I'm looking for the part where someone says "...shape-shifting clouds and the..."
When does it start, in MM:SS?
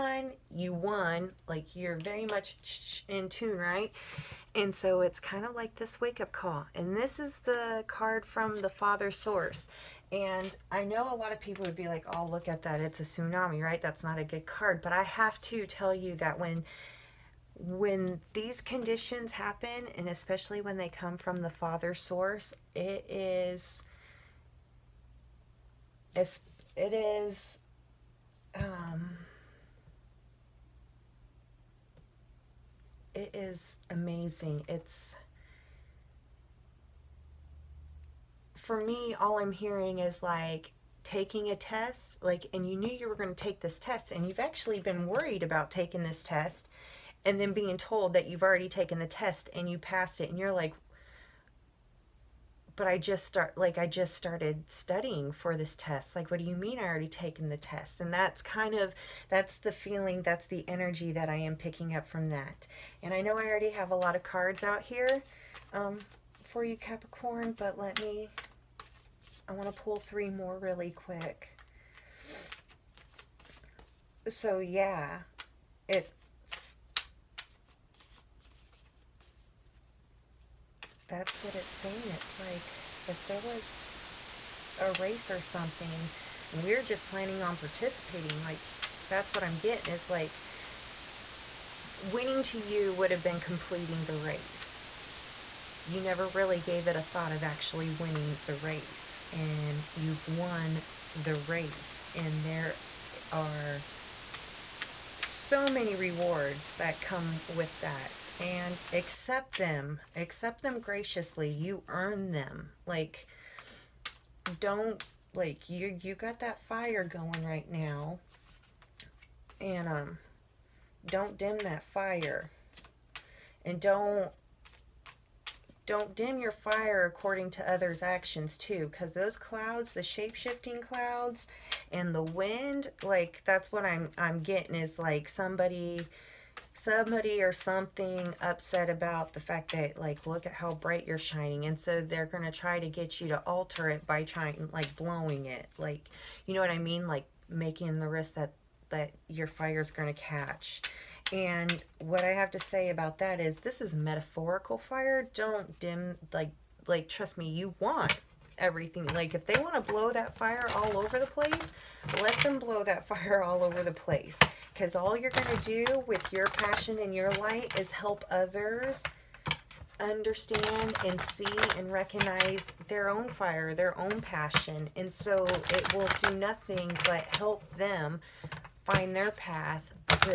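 02:10.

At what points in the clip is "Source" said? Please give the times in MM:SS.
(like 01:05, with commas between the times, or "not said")
00:09, 00:21.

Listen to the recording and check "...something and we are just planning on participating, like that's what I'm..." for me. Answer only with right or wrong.
right.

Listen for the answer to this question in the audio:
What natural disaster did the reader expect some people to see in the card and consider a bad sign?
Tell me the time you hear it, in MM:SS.
00:13.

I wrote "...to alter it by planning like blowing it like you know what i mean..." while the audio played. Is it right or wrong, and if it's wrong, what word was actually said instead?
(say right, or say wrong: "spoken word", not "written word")
wrong: "trying", not "planning".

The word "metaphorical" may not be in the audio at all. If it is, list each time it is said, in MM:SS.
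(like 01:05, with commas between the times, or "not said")
02:33.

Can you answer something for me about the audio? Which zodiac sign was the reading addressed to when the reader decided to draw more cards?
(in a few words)
Capricorn.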